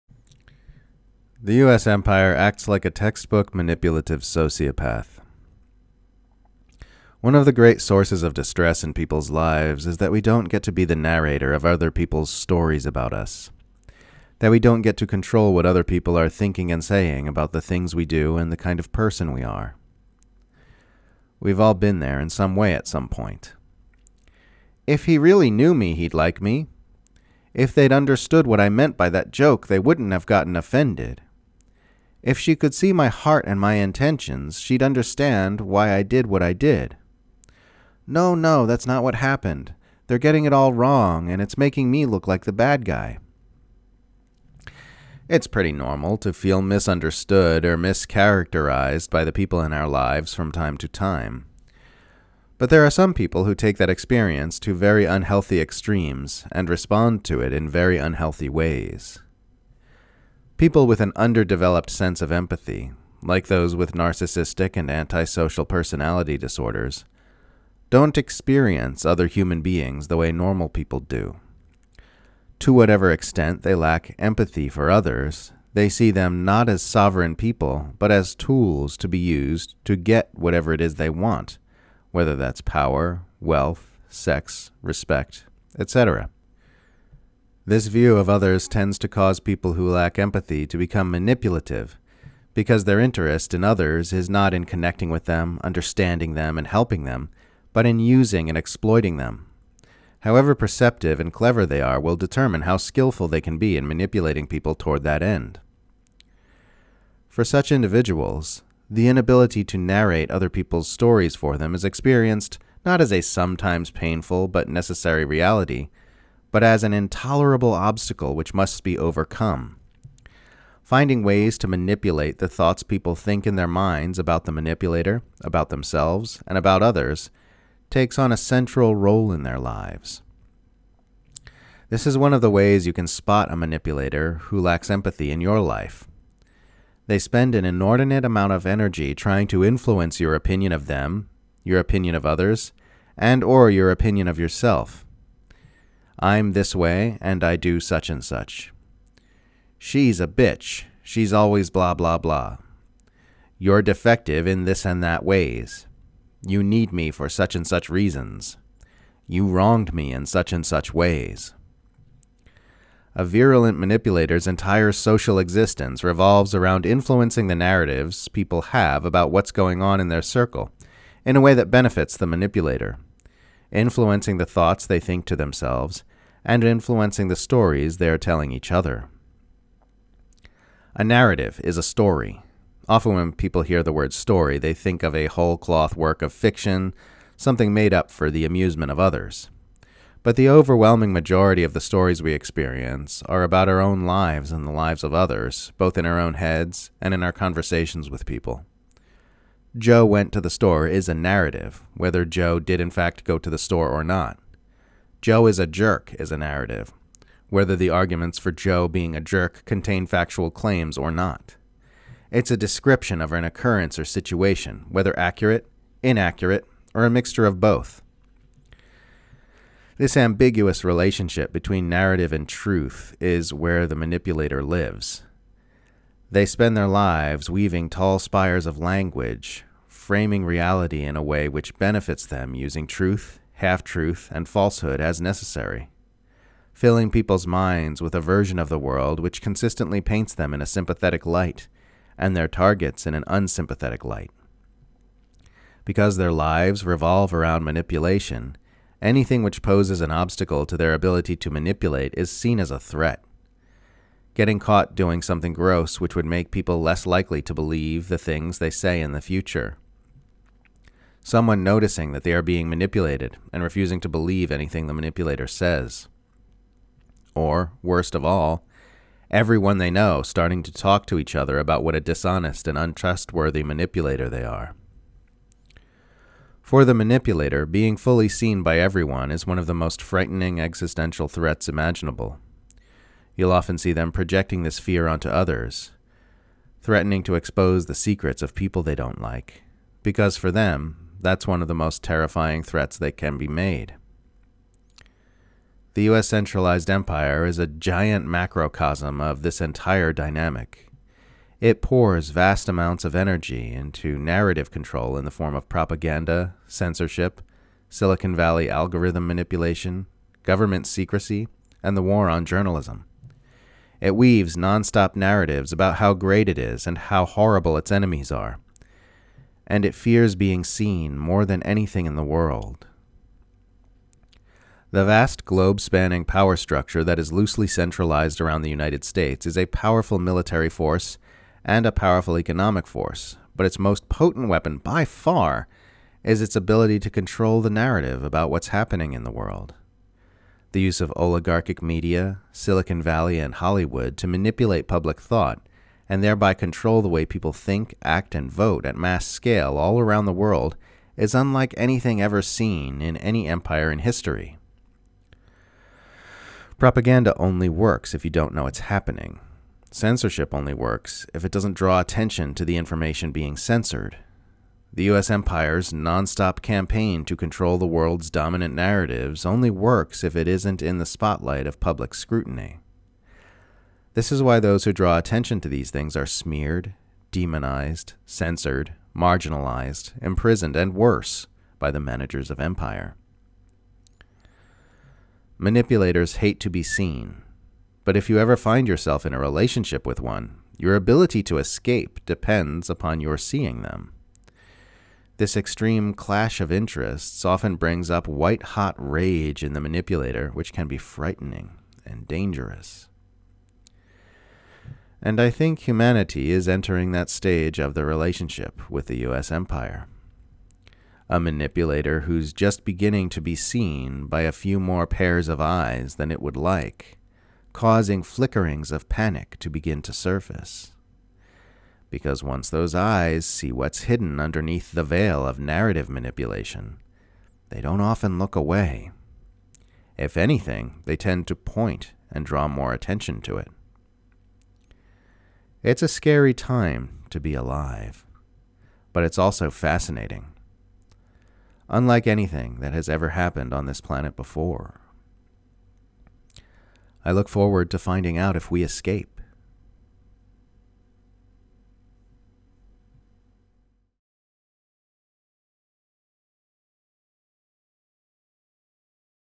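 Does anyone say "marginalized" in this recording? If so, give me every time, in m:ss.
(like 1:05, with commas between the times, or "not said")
6:19.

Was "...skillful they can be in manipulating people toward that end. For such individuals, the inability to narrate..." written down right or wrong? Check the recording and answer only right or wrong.
right.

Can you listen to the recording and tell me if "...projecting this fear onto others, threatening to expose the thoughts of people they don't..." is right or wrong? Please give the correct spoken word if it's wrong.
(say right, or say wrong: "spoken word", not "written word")
wrong: "secrets", not "thoughts".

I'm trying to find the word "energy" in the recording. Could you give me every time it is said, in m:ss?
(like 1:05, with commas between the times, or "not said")
2:18, 5:03.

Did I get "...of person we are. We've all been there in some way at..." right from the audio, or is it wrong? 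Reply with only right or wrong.
right.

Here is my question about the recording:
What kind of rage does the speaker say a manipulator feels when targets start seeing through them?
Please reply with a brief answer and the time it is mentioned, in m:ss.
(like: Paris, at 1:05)
white hot rage, at 6:38.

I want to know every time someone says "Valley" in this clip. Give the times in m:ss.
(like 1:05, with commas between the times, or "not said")
5:08, 5:43.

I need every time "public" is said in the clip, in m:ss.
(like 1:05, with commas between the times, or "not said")
5:44, 6:11.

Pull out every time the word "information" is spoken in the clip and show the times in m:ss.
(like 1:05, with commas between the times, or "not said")
6:02.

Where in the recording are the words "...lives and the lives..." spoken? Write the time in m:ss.
3:14.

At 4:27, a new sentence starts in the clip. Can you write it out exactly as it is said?
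Or, worst of all, everyone they know starting to talk to each other about what a dishonest and untrustworthy manipulator they are.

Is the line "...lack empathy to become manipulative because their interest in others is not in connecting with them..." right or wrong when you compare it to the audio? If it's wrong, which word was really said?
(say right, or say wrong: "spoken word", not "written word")
right.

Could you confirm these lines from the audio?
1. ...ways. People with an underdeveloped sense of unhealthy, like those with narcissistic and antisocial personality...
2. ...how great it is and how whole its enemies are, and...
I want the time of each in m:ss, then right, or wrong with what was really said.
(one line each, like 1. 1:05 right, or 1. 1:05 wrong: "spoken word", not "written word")
1. 0:58 wrong: "empathy", not "unhealthy"
2. 5:15 wrong: "horrible", not "whole".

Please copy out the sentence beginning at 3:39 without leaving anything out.
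This ambiguous relationship between narrative and truth is where the manipulator lives.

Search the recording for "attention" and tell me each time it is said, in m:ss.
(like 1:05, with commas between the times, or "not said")
6:02, 6:15, 7:12.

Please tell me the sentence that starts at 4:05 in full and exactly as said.
Because their lives revolve around manipulation, anything which poses an obstacle to their ability to manipulate is seen as a threat.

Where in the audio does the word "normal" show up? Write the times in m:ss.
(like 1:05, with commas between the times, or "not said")
0:45, 1:10.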